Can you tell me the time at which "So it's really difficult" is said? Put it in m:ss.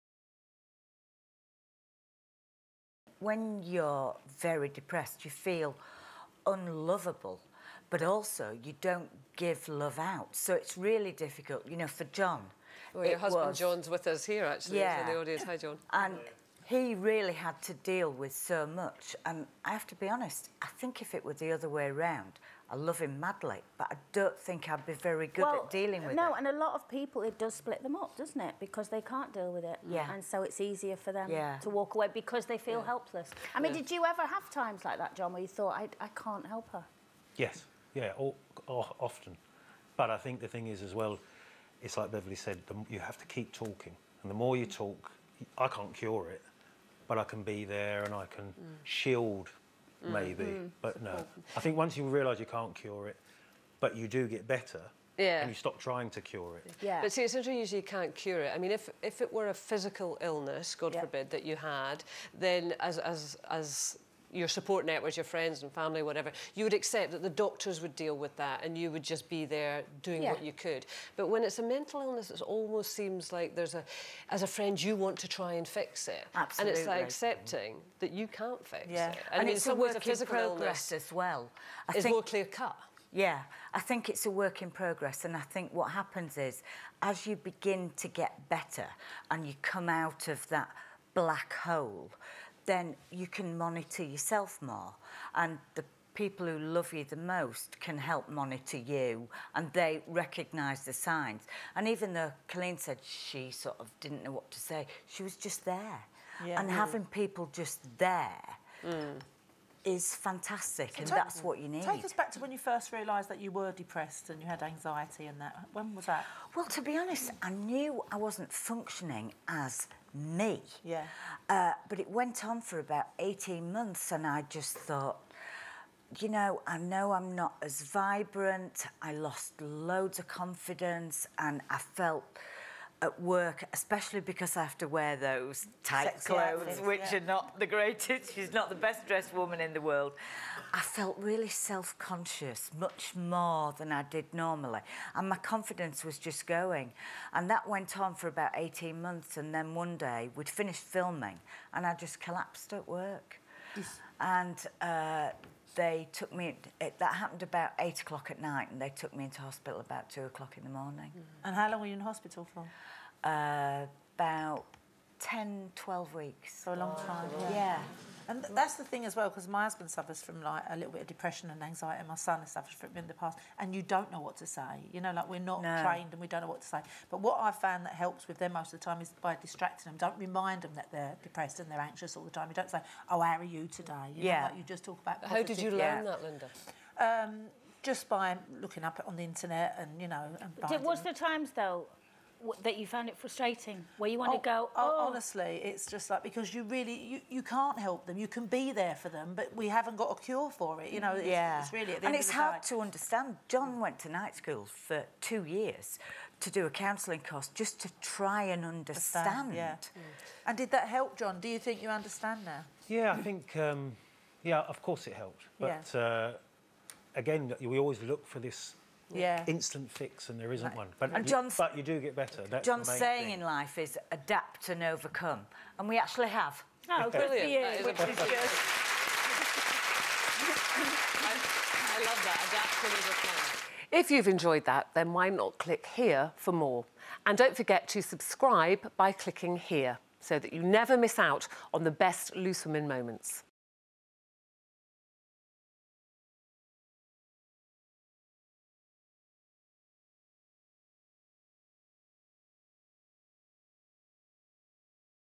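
0:10.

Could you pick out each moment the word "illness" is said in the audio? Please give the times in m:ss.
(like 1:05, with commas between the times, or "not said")
1:00, 1:12.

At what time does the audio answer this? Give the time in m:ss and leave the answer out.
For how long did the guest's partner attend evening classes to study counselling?
3:25.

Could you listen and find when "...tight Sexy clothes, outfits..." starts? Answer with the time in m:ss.
2:15.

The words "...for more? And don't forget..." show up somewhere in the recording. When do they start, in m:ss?
3:56.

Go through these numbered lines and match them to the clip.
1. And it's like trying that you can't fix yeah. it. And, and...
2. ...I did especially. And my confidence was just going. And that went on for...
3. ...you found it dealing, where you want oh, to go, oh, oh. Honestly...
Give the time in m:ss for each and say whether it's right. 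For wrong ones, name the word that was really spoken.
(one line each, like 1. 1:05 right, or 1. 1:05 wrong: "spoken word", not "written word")
1. 1:16 wrong: "accepting", not "trying"
2. 2:23 wrong: "normally", not "especially"
3. 3:12 wrong: "frustrating", not "dealing".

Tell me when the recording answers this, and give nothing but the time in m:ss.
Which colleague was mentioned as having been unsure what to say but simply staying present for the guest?
1:42.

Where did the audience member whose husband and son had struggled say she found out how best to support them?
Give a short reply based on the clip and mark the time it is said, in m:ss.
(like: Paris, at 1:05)
The internet, at 3:09.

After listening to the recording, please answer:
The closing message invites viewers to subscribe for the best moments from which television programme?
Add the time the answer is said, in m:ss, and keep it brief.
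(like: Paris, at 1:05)
Loose Women, at 4:02.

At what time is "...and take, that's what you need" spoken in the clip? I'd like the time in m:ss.
1:50.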